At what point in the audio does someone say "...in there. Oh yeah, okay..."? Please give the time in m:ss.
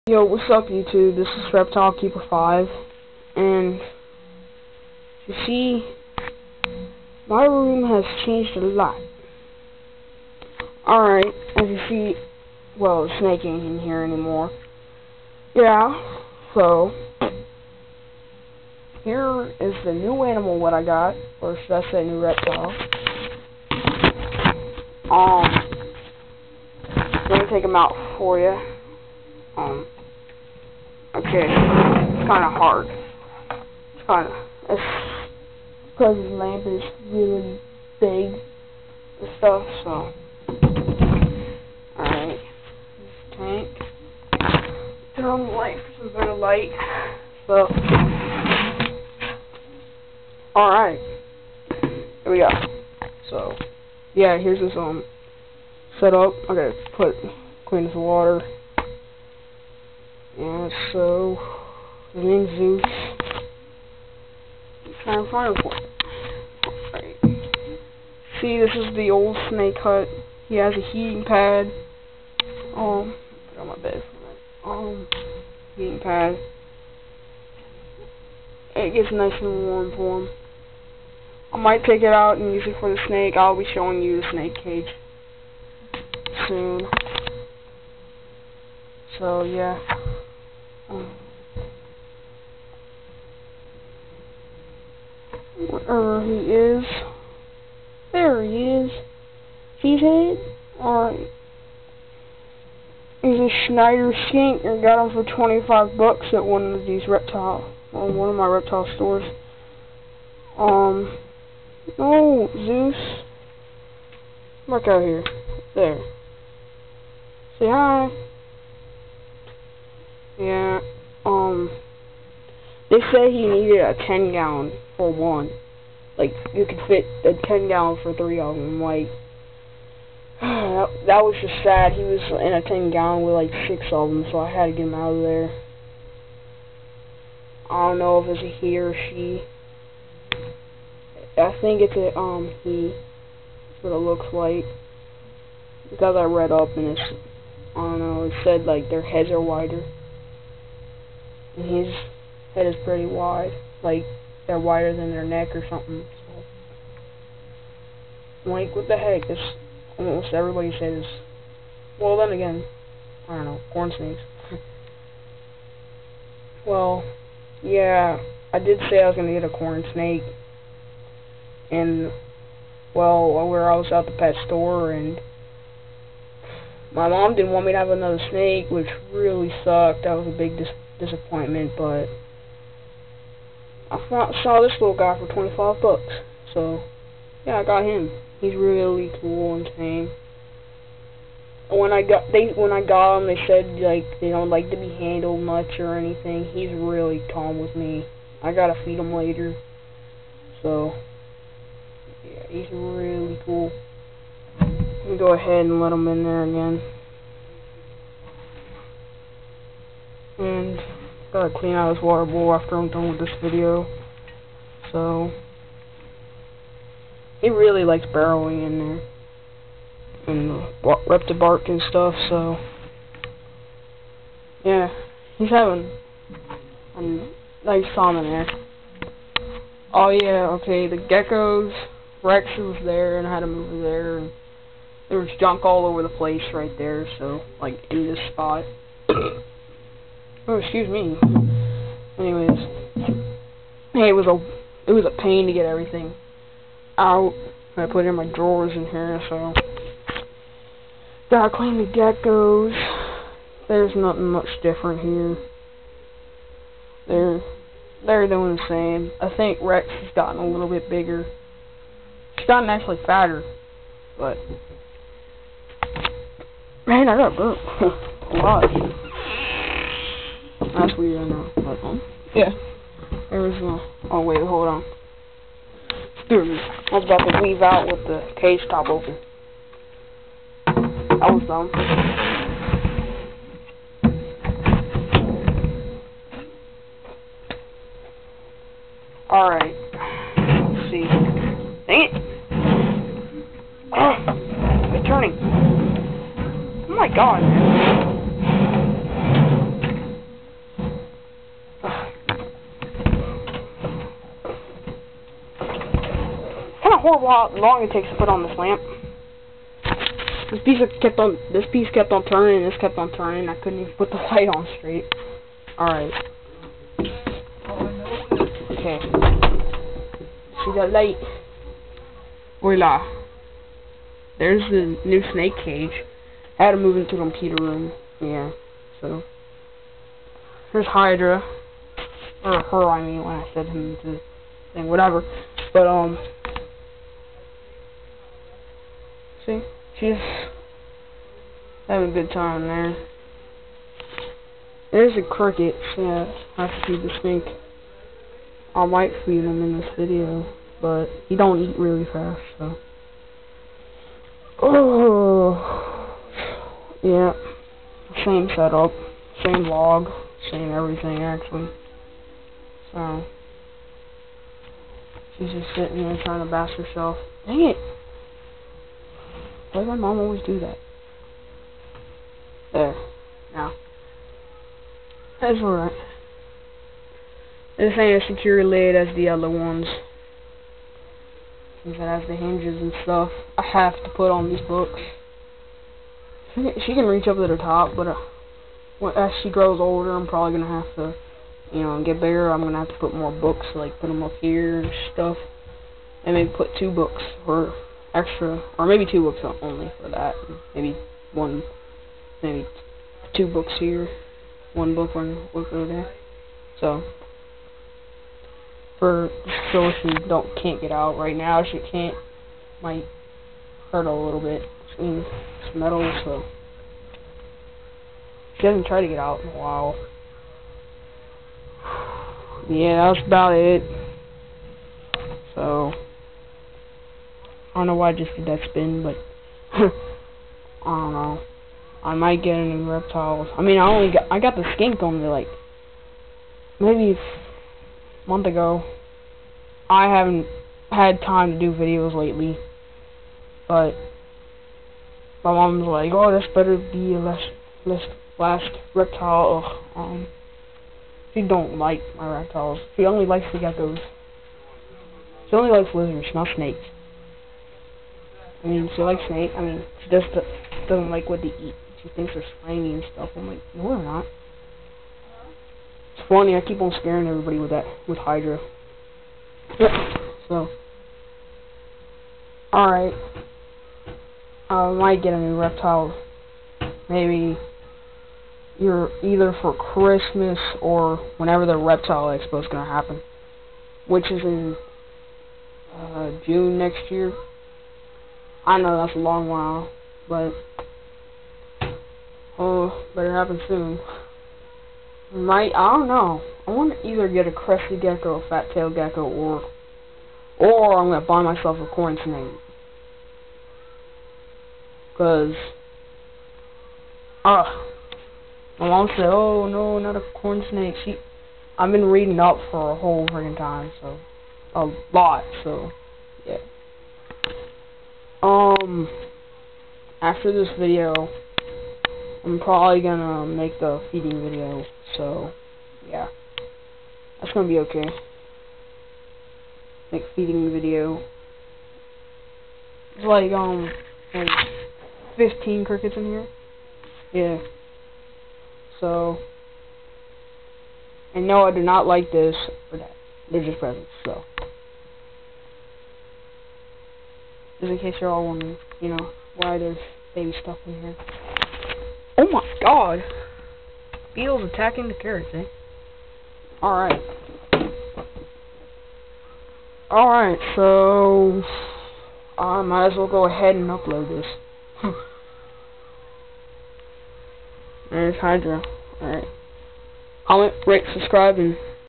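3:48.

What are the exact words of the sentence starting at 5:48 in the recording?
I might feed him in this video, but he don't eat really fast, so.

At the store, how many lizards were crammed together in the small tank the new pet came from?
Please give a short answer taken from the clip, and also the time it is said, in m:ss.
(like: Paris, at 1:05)
six, at 2:13.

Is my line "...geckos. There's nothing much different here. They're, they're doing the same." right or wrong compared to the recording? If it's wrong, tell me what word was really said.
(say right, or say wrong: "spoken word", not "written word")
right.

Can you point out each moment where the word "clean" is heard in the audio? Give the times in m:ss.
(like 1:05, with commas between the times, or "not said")
0:57, 3:31, 4:11.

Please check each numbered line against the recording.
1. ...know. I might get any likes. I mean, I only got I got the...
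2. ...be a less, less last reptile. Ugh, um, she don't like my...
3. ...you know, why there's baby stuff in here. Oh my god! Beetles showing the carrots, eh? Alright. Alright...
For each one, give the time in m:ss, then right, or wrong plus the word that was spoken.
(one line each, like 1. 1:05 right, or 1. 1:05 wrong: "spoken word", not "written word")
1. 7:11 wrong: "reptiles", not "likes"
2. 7:26 right
3. 9:08 wrong: "attacking", not "showing".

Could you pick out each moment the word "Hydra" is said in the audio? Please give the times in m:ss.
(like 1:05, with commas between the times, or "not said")
5:30, 7:48, 9:28.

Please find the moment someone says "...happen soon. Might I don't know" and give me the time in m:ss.
8:13.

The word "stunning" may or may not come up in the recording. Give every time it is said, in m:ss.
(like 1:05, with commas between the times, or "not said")
not said.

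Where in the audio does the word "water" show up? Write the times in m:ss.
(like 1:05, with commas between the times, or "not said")
0:57, 3:32.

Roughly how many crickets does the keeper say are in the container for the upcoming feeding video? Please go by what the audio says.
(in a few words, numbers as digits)
15.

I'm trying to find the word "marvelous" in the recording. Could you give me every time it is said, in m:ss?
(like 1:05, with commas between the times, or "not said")
not said.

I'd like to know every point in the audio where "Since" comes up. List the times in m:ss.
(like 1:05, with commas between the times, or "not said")
6:21.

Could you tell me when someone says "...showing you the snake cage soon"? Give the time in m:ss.
1:23.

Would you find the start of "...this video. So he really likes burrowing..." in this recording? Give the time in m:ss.
3:33.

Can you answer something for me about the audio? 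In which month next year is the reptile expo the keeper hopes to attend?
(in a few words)
June.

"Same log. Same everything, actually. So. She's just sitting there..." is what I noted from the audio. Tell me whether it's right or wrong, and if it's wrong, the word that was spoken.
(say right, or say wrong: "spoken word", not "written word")
right.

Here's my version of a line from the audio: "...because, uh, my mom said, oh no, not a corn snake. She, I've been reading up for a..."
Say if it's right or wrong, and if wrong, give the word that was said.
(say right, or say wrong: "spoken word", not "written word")
right.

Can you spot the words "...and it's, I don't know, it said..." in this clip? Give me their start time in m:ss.
2:26.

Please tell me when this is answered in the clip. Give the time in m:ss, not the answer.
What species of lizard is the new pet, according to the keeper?
1:43.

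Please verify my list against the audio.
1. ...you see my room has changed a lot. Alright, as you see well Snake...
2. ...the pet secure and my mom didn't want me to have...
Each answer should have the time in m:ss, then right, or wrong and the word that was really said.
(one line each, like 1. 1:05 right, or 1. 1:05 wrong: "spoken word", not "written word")
1. 0:05 right
2. 2:54 wrong: "store", not "secure".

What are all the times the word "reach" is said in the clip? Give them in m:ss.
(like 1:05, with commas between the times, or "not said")
6:27.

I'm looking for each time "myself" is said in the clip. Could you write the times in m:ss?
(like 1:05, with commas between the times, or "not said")
8:21.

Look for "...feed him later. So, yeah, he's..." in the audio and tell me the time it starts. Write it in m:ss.
3:18.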